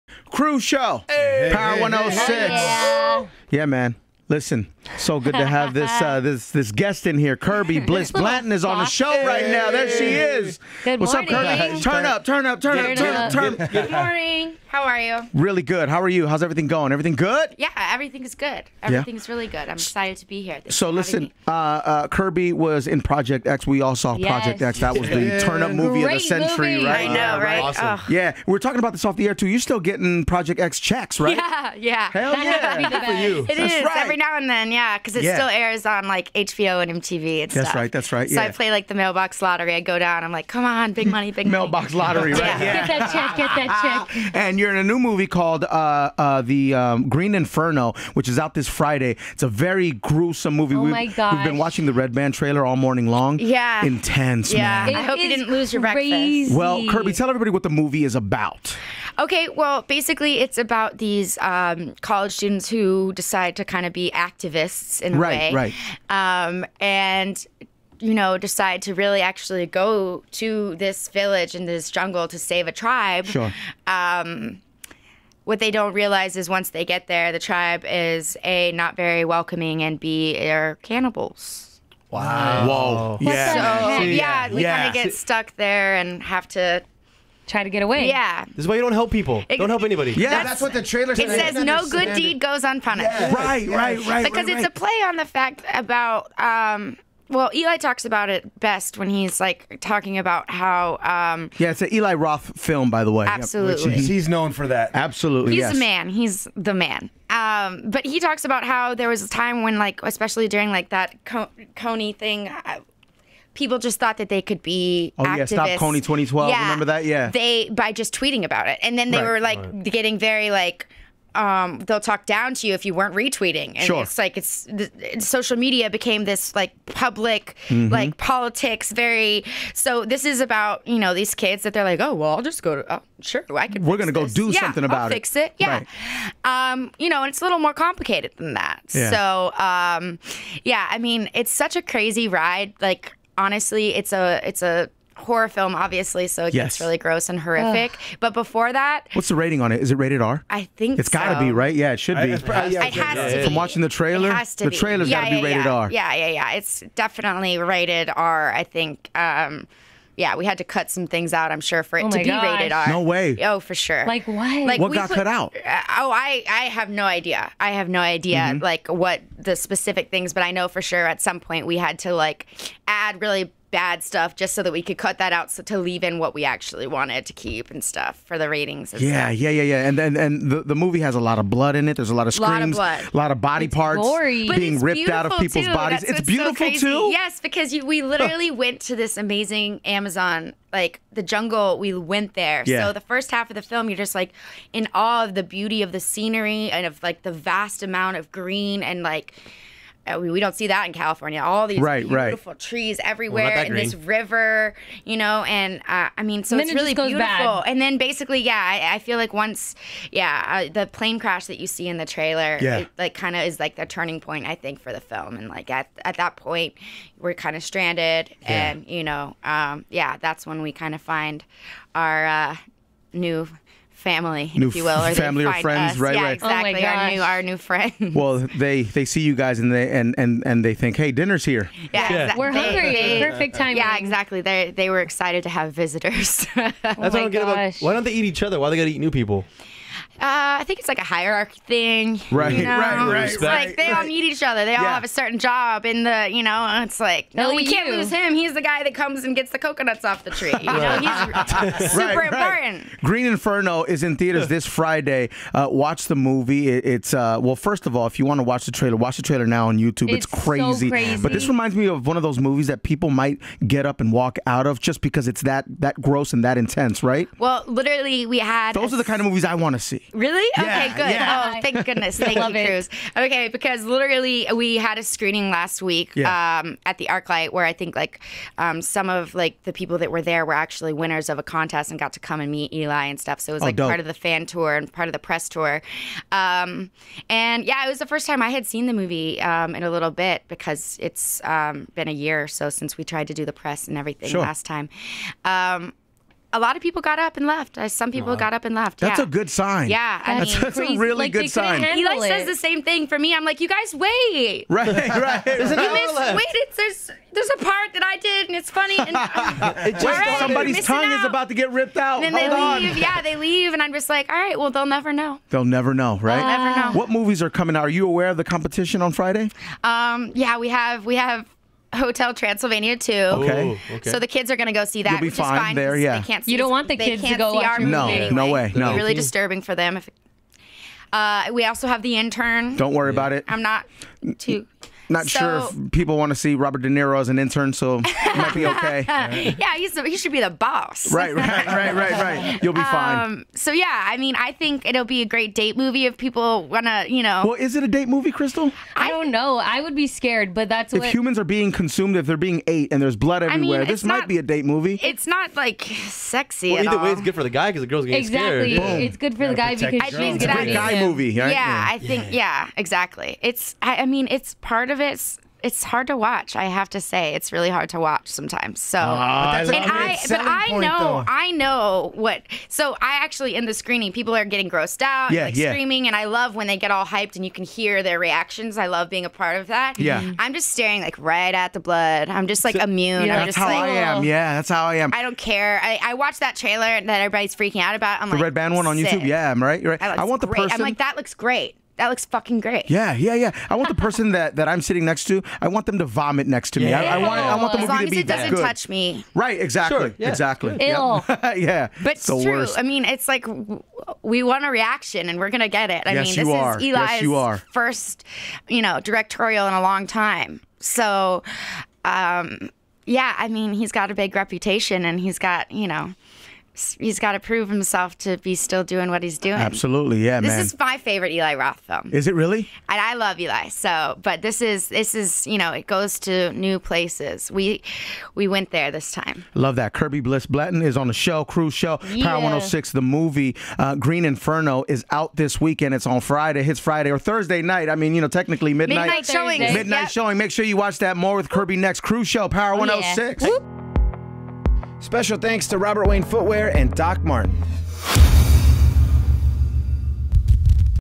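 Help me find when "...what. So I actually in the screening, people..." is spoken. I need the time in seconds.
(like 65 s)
372 s.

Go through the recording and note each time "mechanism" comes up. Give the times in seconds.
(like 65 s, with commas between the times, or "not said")
not said.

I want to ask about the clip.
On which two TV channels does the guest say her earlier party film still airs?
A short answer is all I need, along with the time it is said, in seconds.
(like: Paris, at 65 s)
HBO and MTV, at 36 s.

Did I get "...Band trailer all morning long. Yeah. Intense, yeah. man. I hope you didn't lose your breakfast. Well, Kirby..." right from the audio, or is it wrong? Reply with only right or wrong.
right.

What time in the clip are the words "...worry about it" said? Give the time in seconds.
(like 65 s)
332 s.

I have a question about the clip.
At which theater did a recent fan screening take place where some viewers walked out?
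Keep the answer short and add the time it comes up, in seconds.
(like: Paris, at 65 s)
ArcLight, at 277 s.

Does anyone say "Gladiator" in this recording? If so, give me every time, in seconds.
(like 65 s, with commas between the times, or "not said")
not said.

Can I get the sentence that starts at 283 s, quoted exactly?
So it was oh, like oh, part of the fan tour and part of the press tour.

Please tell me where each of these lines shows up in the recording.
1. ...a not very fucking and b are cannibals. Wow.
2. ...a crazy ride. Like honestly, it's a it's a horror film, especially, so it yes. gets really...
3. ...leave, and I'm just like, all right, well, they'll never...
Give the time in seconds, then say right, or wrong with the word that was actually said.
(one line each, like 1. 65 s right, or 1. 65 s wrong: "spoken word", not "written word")
1. 78 s wrong: "welcoming", not "fucking"
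2. 141 s wrong: "obviously", not "especially"
3. 313 s right.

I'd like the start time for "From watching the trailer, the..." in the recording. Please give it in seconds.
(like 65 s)
153 s.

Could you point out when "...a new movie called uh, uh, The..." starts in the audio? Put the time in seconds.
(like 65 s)
44 s.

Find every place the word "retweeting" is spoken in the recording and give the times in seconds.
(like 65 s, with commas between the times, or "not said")
123 s.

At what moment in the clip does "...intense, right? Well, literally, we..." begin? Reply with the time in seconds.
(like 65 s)
266 s.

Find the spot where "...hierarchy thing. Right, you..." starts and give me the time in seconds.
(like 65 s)
241 s.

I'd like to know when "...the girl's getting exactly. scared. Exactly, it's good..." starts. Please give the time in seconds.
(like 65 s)
357 s.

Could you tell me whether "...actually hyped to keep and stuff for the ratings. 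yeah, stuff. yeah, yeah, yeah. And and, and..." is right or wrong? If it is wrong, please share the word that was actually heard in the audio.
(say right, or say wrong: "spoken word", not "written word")
wrong: "wanted", not "hyped".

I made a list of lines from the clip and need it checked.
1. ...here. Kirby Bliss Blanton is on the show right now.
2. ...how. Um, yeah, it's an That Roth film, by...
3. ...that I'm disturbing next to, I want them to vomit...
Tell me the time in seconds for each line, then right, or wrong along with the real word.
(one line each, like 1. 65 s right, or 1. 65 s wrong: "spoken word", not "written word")
1. 7 s right
2. 100 s wrong: "Eli", not "That"
3. 394 s wrong: "sitting", not "disturbing".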